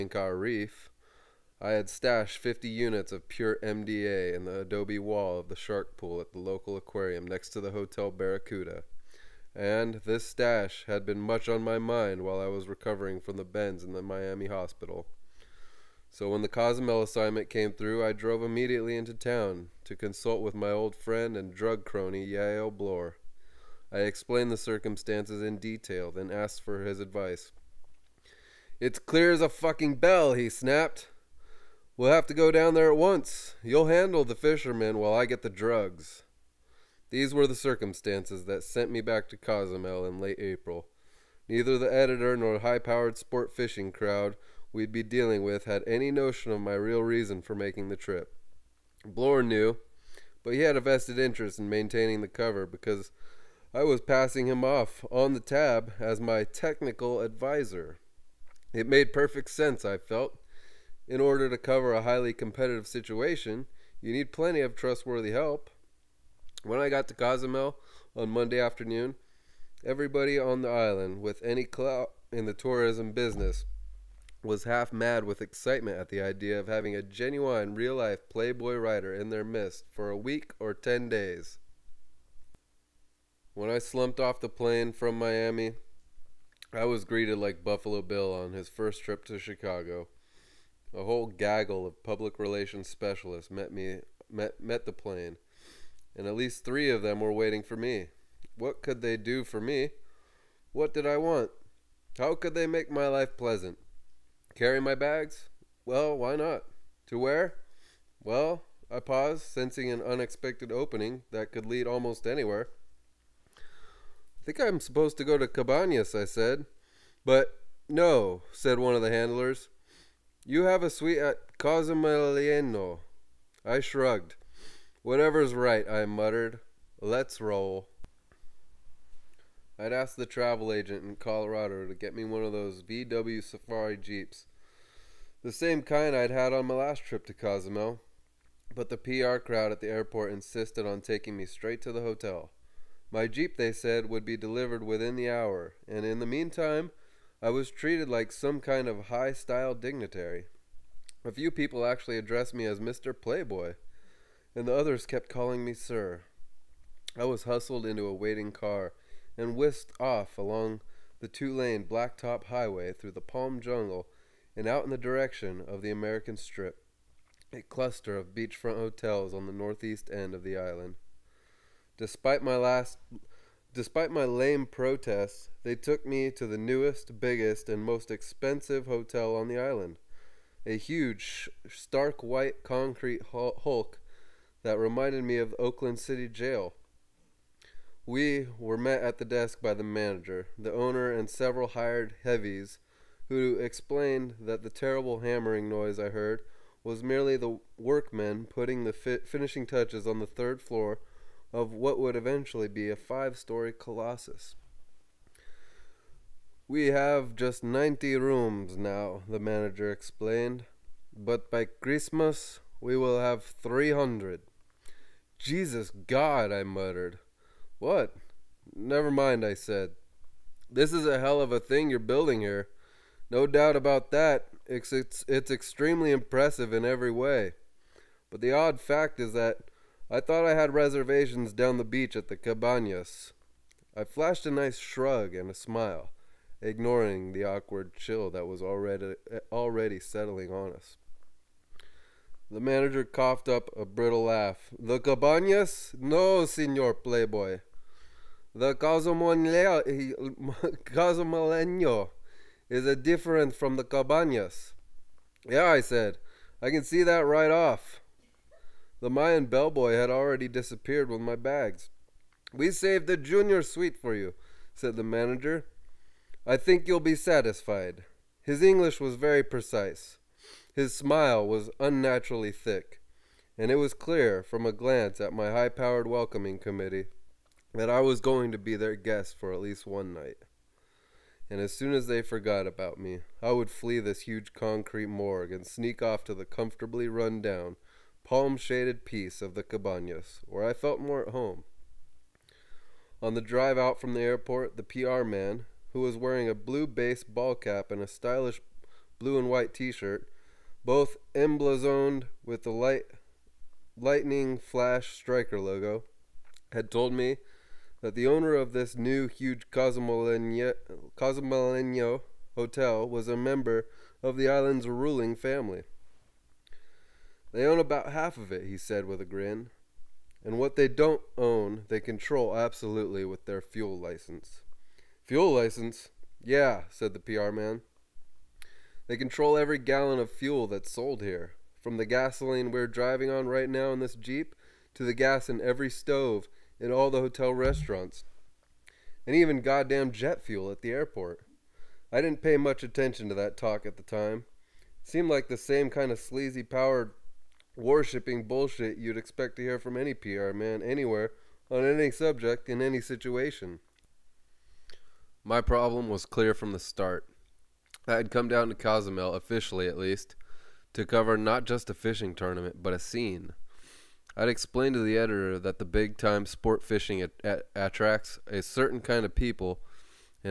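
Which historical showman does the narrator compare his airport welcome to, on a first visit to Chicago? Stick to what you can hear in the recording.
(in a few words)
Buffalo Bill.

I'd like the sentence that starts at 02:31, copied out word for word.
A few people actually addressed me as Mr.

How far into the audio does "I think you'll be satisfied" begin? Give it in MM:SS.
04:26.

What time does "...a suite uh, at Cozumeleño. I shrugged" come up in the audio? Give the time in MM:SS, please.
02:00.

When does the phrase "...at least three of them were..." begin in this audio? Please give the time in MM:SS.
01:36.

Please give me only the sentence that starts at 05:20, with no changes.
And what they don't own, they control absolutely with their fuel license.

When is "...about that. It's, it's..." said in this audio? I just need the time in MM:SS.
03:43.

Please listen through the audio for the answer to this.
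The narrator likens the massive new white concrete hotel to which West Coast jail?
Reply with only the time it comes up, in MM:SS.
03:05.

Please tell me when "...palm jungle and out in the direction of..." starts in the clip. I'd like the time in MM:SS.
02:43.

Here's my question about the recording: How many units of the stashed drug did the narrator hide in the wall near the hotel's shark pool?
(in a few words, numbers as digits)
50.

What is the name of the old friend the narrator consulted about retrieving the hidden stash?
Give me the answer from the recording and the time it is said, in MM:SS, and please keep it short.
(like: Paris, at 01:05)
Yail Bloor, at 00:22.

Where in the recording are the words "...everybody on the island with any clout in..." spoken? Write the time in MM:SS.
01:09.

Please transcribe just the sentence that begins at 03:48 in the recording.
But the odd fact is that I thought I had reservations down the beach at the Cabanas.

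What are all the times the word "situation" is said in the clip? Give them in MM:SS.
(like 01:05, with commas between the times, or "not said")
01:02, 05:53.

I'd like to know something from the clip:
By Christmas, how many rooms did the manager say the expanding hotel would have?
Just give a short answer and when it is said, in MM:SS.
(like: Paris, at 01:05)
300, at 03:33.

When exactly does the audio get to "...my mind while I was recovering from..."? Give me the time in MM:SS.
00:11.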